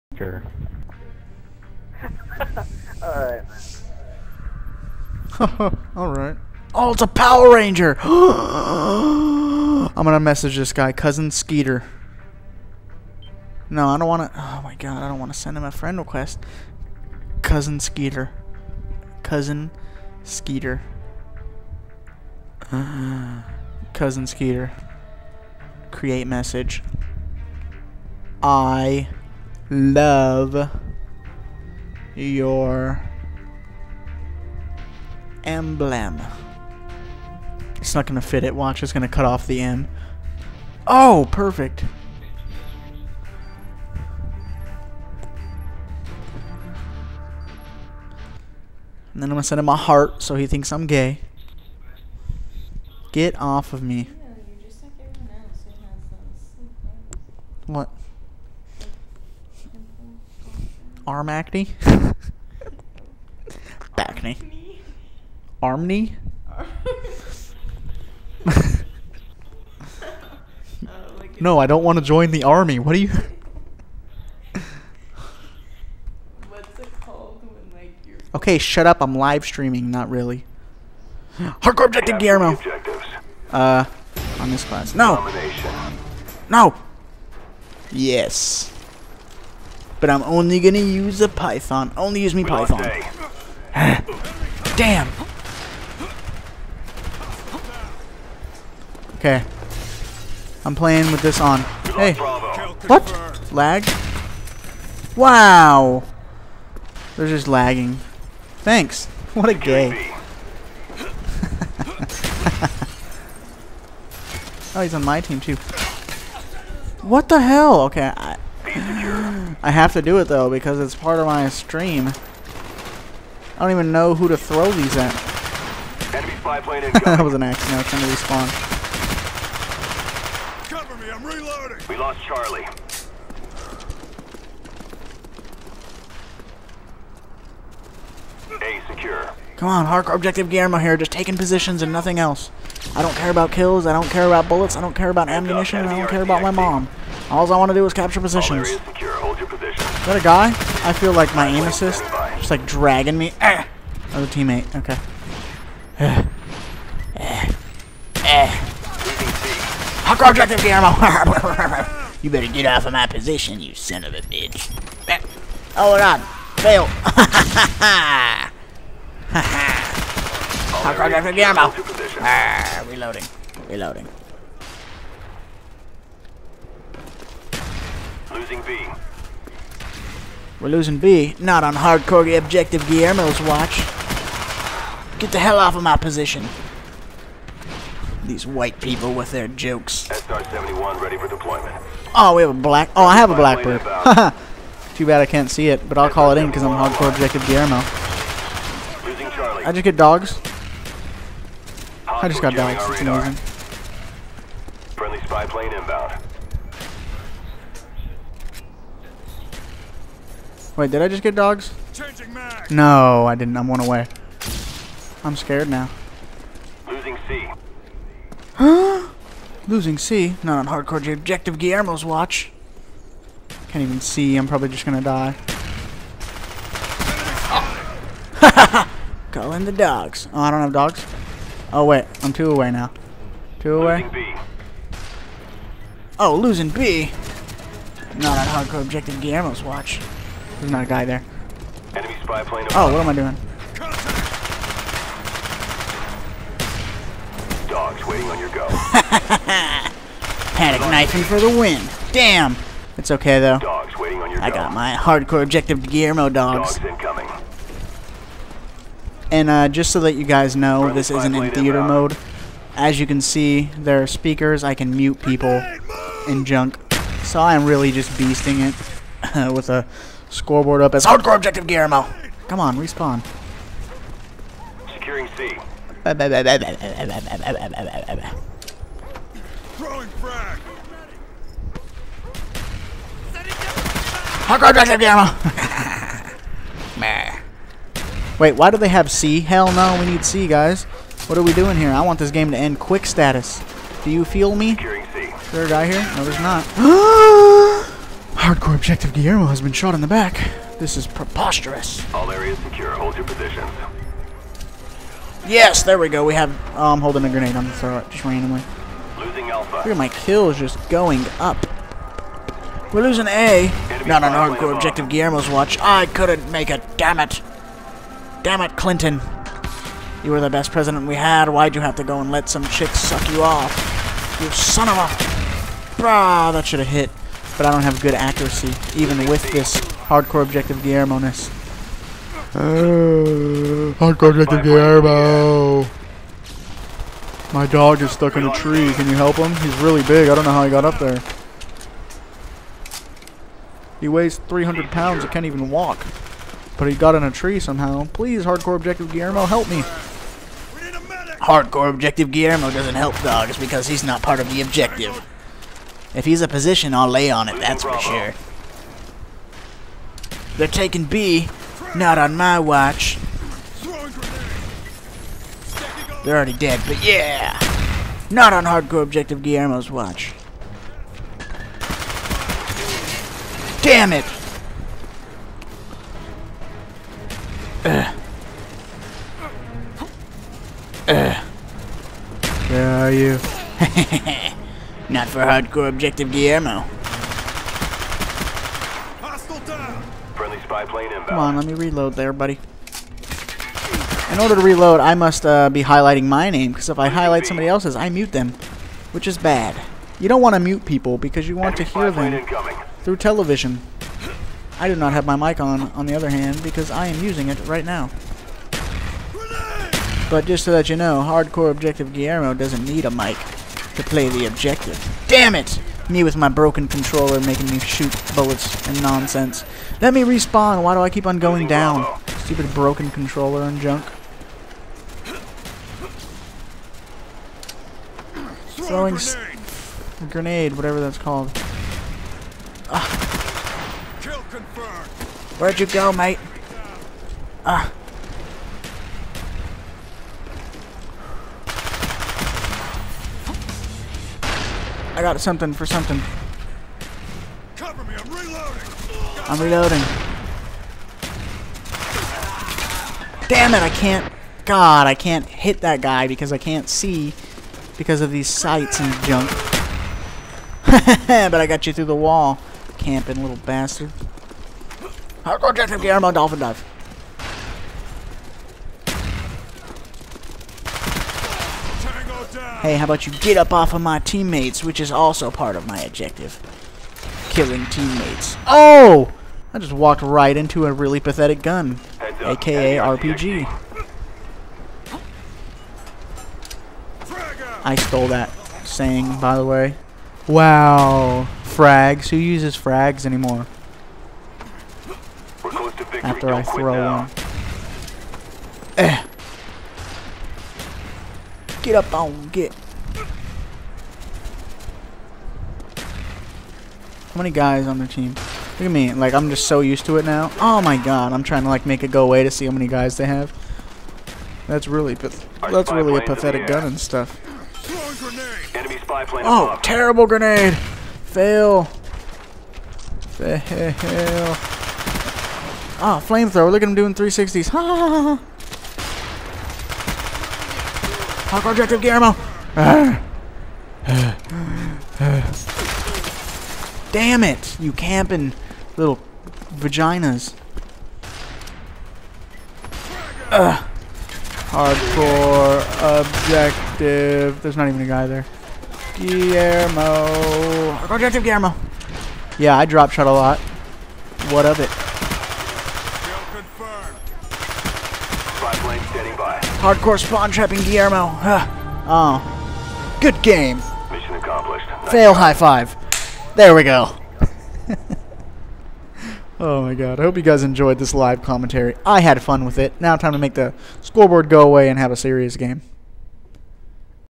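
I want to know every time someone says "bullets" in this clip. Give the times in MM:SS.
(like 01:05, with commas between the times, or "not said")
02:24, 06:58.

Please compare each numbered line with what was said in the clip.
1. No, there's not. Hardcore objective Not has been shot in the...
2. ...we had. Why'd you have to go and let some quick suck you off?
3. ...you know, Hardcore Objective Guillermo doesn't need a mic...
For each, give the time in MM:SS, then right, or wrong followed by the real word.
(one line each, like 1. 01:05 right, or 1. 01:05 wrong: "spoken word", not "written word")
1. 04:56 wrong: "Guillermo", not "Not"
2. 05:21 wrong: "chick", not "quick"
3. 06:50 right.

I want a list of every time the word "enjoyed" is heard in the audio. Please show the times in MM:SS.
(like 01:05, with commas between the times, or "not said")
09:30.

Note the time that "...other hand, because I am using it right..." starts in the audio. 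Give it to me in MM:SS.
06:46.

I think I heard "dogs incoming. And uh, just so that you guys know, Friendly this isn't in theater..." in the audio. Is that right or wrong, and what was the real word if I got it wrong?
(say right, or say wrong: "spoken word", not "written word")
right.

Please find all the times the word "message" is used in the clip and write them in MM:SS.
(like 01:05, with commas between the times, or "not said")
00:10, 00:26.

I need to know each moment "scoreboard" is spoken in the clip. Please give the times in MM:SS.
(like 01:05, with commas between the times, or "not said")
04:30, 09:34.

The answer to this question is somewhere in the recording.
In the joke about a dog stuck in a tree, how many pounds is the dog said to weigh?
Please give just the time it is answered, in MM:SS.
05:43.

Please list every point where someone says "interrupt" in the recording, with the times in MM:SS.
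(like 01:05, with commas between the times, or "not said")
not said.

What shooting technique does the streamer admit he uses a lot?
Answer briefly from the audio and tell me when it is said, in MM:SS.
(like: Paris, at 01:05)
Drop shot, at 09:12.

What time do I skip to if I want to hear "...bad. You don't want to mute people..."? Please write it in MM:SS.
06:39.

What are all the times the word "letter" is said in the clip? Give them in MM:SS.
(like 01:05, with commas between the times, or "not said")
not said.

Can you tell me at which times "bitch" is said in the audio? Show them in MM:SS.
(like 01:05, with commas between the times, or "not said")
02:44.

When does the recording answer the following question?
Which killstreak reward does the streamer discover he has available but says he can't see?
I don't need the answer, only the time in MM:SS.
03:12.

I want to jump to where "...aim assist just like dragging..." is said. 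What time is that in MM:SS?
02:31.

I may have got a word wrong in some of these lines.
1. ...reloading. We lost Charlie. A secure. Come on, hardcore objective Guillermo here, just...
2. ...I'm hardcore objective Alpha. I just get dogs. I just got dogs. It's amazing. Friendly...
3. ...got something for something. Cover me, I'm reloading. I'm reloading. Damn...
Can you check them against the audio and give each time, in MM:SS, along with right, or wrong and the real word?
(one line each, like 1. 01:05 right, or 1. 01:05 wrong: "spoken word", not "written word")
1. 02:11 right
2. 03:16 wrong: "Guillermo", not "Alpha"
3. 07:25 right.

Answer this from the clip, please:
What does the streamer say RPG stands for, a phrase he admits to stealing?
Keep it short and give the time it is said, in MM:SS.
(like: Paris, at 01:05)
Really pathetic gun, at 08:00.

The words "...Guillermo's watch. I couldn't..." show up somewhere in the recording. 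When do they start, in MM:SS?
05:15.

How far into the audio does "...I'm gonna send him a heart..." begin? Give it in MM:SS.
00:49.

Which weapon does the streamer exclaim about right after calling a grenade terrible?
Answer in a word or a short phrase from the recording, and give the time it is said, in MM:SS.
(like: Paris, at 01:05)
Flamethrower, at 08:46.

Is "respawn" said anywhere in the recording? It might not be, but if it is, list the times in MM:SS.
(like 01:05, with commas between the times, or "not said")
02:08, 04:32, 07:00.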